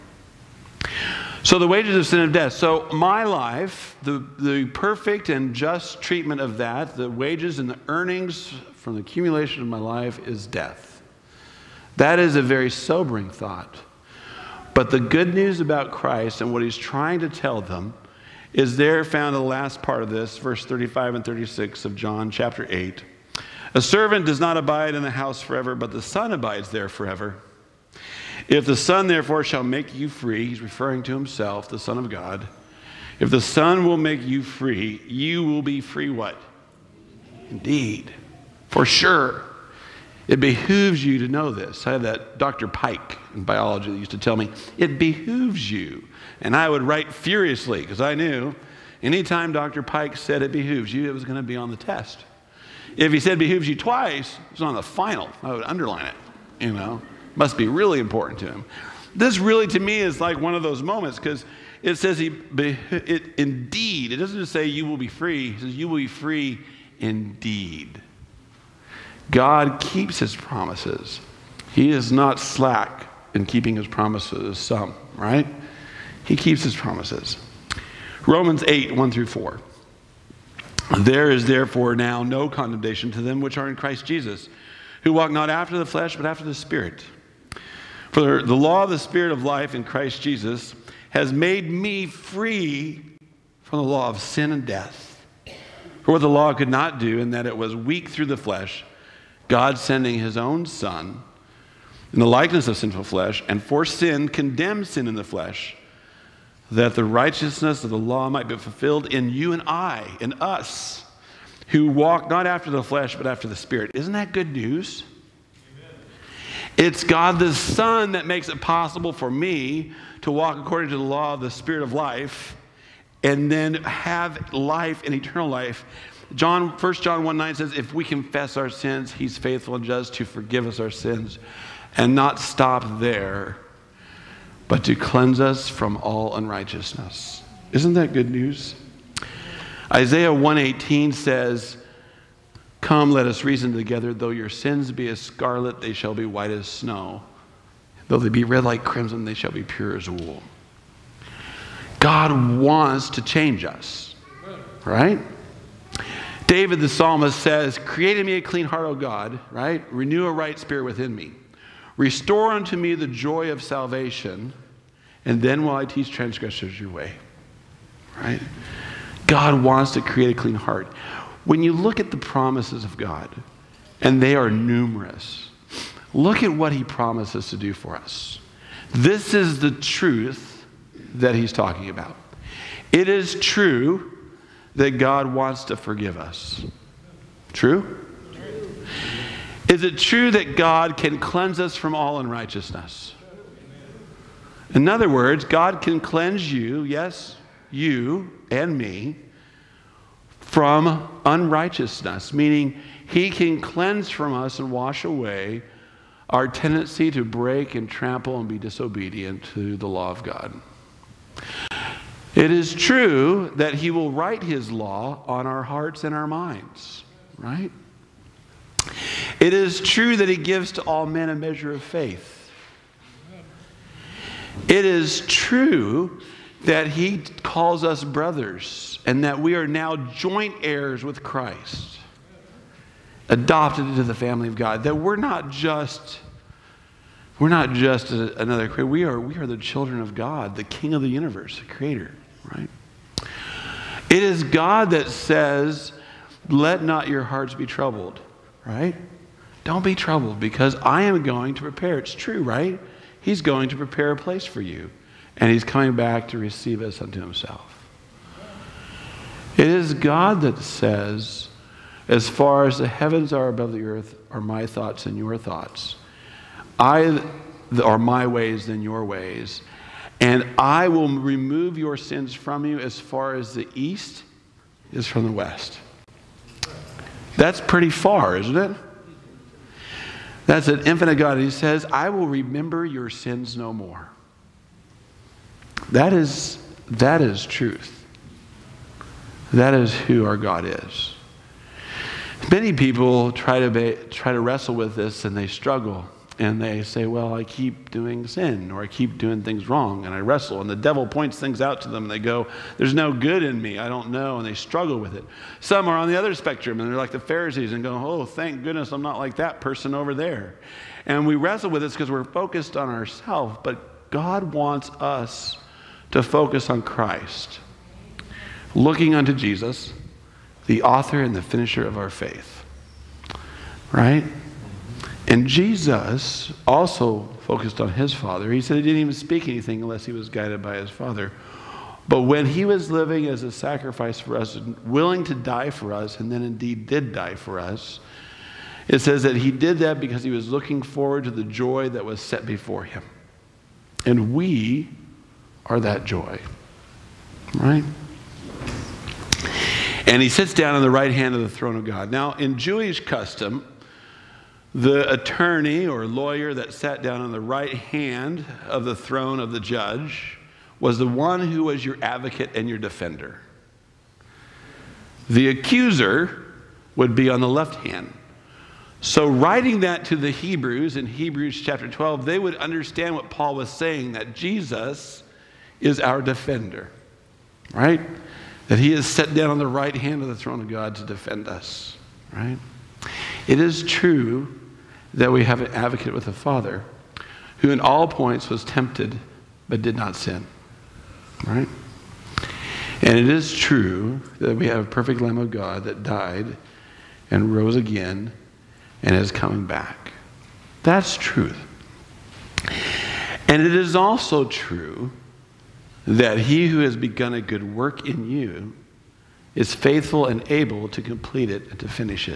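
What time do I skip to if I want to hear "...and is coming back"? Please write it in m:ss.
6:39.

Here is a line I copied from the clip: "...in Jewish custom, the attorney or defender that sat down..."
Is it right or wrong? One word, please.
wrong.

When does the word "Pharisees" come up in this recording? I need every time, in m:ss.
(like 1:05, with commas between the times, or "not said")
5:07.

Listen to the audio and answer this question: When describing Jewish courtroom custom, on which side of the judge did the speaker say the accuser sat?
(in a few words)
left hand.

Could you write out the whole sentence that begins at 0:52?
If he said behooves you twice, it was on the final.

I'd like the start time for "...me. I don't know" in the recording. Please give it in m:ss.
5:03.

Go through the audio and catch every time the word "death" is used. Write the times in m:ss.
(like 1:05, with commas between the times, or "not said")
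0:02, 0:10, 1:34.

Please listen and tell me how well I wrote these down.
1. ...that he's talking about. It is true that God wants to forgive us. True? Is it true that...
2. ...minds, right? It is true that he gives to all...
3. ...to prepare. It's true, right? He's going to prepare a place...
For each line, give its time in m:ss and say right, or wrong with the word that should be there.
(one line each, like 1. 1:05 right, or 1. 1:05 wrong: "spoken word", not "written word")
1. 3:01 right
2. 3:36 right
3. 4:11 right.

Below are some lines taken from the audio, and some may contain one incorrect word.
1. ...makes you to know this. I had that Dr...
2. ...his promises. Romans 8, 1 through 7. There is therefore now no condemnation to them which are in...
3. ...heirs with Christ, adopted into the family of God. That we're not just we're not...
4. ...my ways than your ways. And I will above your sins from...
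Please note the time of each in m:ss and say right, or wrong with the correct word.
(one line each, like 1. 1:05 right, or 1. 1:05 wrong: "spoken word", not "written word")
1. 0:40 wrong: "behooves", not "makes"
2. 1:16 wrong: "4", not "7"
3. 3:50 right
4. 4:27 wrong: "remove", not "above".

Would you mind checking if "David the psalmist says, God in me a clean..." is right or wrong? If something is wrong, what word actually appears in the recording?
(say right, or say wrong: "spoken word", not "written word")
wrong: "Create", not "God".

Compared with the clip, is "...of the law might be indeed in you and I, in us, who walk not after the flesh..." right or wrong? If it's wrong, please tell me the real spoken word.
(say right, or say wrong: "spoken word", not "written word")
wrong: "fulfilled", not "indeed".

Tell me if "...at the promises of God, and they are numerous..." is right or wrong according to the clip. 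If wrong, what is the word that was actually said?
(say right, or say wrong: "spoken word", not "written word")
right.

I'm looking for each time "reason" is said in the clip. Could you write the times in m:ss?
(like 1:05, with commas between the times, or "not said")
2:23.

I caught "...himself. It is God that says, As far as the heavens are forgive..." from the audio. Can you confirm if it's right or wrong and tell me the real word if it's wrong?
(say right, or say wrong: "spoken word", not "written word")
wrong: "above", not "forgive".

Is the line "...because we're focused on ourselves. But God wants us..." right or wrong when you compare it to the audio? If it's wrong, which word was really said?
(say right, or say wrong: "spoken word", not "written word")
right.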